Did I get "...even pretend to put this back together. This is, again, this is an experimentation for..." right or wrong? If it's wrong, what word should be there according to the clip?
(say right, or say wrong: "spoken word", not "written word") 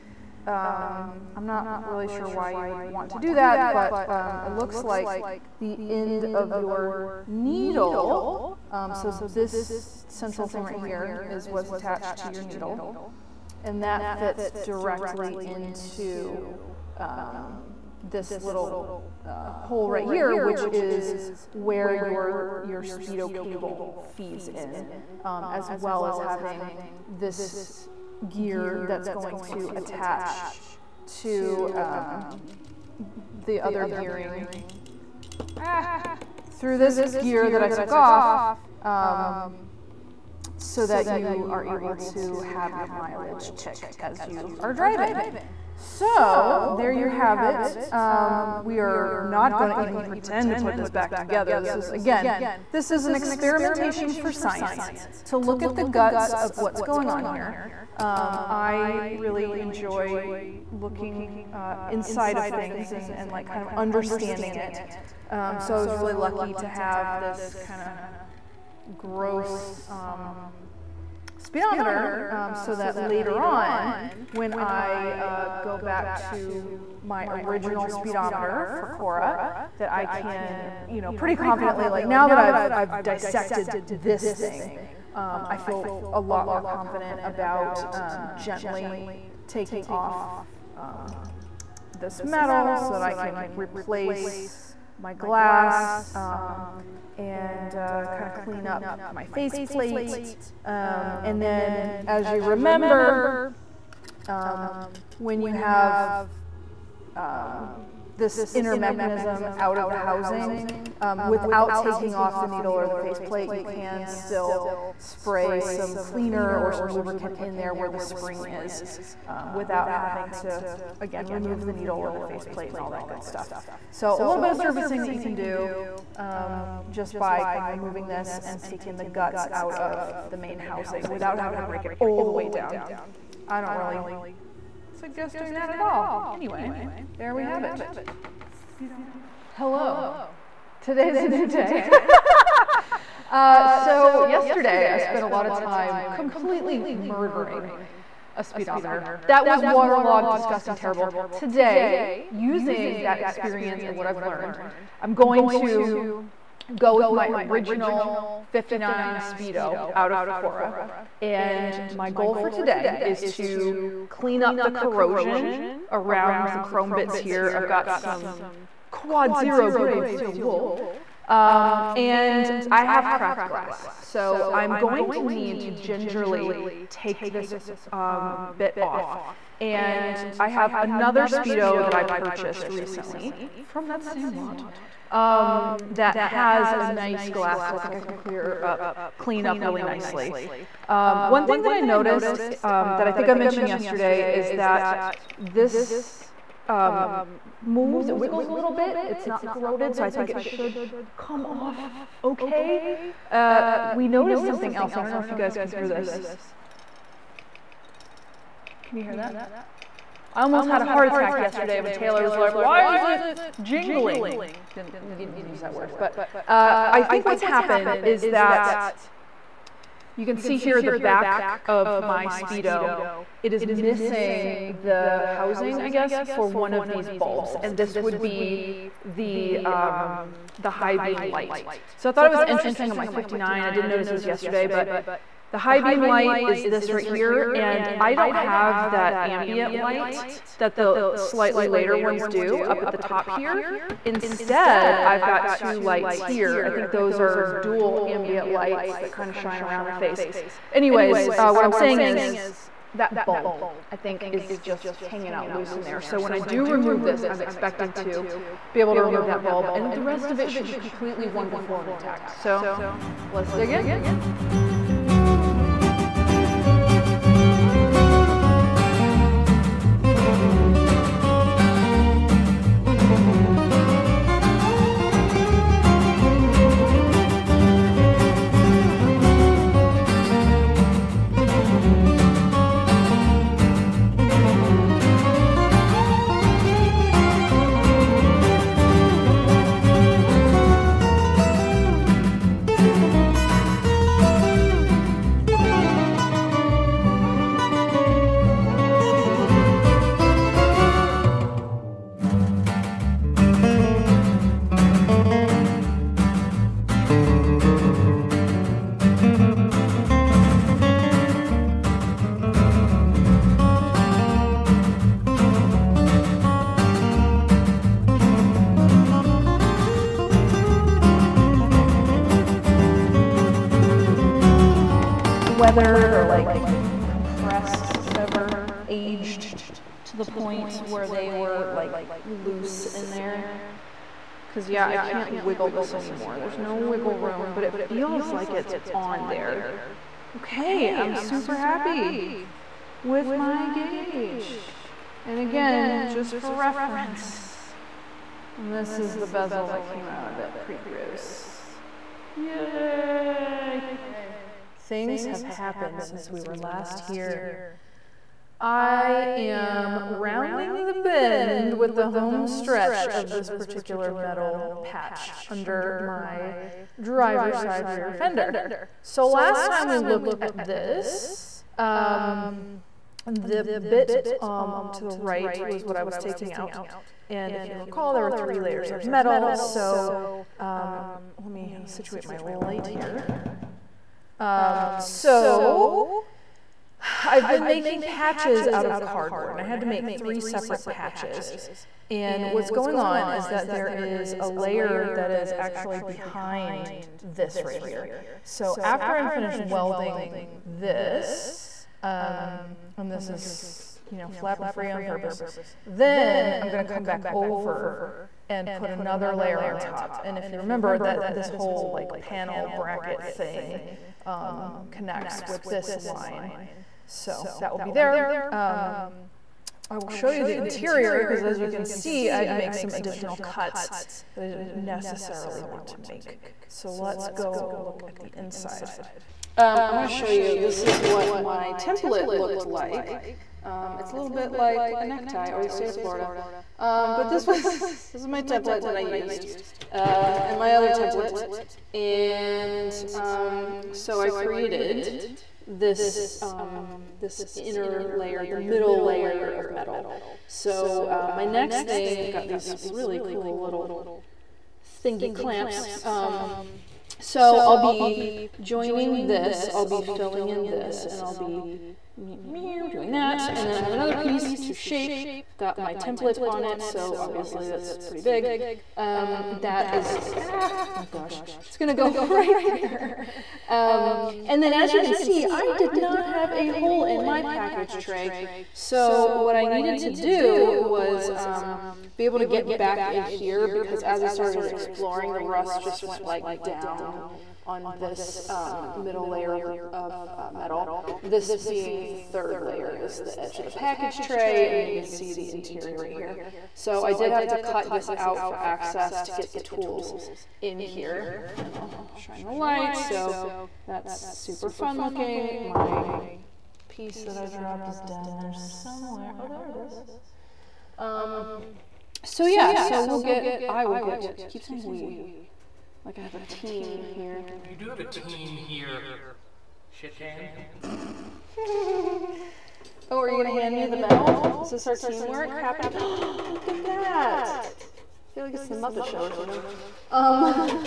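right.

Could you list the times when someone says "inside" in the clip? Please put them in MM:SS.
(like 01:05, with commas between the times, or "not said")
01:01, 07:08.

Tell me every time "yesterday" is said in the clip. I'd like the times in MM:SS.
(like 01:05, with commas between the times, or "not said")
02:24, 03:13, 03:31, 03:54.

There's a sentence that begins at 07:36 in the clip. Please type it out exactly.
Um, so I'll be joining this, I'll be filling in this, and I'll be doing that.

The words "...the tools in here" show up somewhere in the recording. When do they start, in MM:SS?
08:19.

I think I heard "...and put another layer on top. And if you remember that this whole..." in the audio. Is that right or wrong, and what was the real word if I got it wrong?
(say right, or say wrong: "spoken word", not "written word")
right.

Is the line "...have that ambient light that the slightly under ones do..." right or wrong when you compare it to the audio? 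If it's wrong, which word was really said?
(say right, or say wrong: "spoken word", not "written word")
wrong: "later", not "under".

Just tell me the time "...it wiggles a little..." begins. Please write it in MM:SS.
03:18.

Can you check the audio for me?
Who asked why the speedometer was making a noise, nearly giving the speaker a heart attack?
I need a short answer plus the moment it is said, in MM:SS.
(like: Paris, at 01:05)
Taylor, at 03:31.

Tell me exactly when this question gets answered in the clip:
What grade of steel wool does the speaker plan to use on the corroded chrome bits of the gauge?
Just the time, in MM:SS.
02:48.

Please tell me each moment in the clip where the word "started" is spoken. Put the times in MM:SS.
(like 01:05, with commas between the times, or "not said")
08:04.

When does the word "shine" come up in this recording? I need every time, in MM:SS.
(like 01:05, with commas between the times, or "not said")
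04:09, 08:22.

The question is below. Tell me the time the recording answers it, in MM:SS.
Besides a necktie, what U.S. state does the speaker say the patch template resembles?
07:15.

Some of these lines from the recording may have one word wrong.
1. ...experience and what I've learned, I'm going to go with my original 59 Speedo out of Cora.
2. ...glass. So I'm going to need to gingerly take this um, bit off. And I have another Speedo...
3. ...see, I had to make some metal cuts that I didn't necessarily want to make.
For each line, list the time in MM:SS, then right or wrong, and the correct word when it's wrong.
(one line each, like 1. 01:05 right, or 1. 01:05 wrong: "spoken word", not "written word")
1. 02:33 right
2. 02:53 right
3. 07:01 wrong: "additional", not "metal".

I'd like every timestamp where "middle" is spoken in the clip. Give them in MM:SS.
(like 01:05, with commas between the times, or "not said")
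07:28, 08:08.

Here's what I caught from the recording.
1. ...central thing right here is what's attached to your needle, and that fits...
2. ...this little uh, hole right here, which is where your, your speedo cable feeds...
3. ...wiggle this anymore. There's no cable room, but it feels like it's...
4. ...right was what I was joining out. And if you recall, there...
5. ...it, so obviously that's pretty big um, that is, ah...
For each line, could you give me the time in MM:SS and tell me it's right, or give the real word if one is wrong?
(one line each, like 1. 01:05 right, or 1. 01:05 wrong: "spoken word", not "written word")
1. 00:10 right
2. 00:18 right
3. 05:35 wrong: "wiggle", not "cable"
4. 06:15 wrong: "taking", not "joining"
5. 07:46 right.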